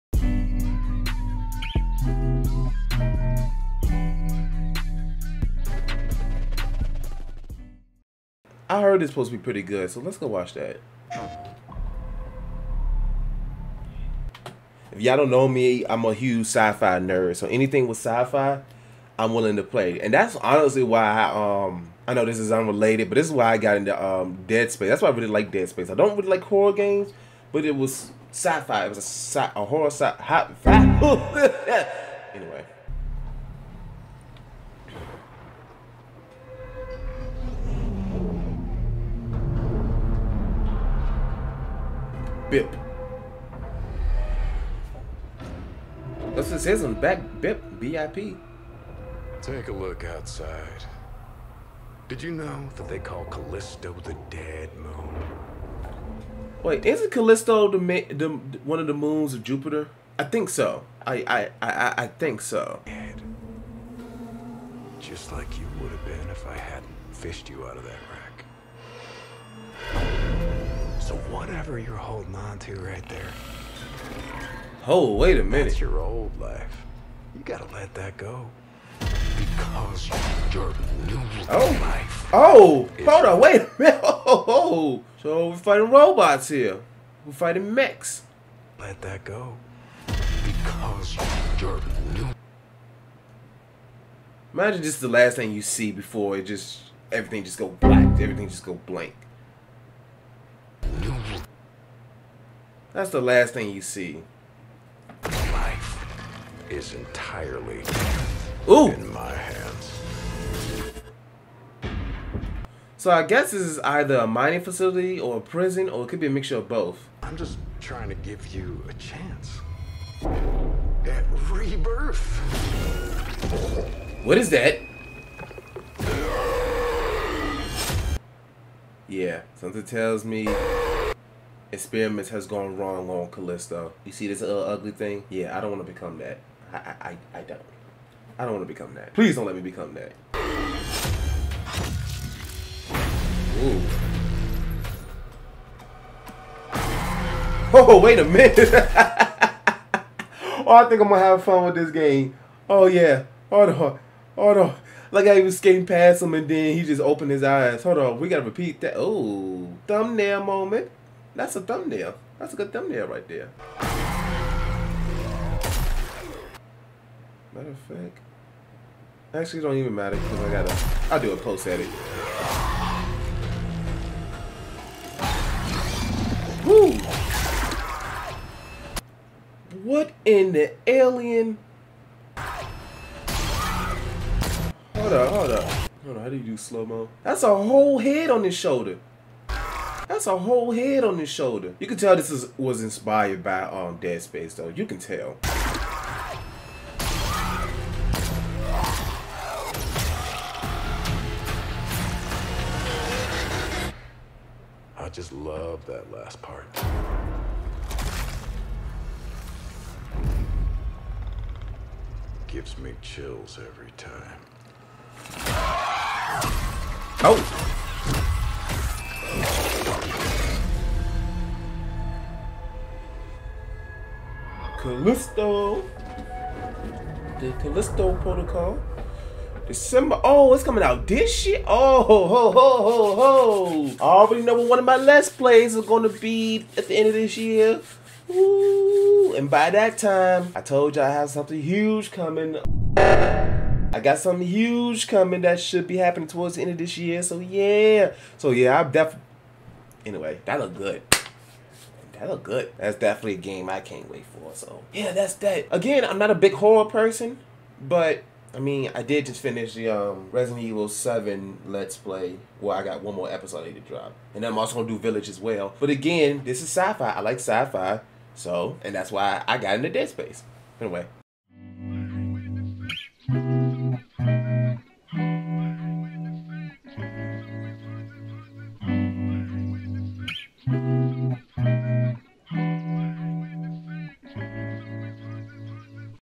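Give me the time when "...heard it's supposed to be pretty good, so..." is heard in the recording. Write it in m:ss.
0:08.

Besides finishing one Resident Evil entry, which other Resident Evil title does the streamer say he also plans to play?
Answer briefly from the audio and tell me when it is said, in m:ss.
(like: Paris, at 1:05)
Village, at 4:24.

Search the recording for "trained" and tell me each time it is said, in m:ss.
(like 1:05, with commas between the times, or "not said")
not said.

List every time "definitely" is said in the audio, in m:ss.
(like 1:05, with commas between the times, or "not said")
4:08, 4:12.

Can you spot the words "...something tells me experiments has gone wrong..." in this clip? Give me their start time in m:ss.
2:09.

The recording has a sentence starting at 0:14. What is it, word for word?
If y'all don't know me, I'm a huge sci-fi nerd.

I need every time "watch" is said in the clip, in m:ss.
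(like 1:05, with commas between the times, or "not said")
0:10.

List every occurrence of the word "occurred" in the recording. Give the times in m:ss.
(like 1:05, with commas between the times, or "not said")
not said.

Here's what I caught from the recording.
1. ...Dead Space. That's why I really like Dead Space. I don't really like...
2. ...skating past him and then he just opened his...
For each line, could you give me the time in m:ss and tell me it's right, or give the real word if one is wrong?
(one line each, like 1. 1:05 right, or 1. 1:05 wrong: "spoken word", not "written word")
1. 0:24 right
2. 2:35 right.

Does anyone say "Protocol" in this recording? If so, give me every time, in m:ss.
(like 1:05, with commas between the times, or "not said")
3:48.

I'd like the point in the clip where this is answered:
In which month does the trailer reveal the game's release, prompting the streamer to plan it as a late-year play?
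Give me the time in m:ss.
3:49.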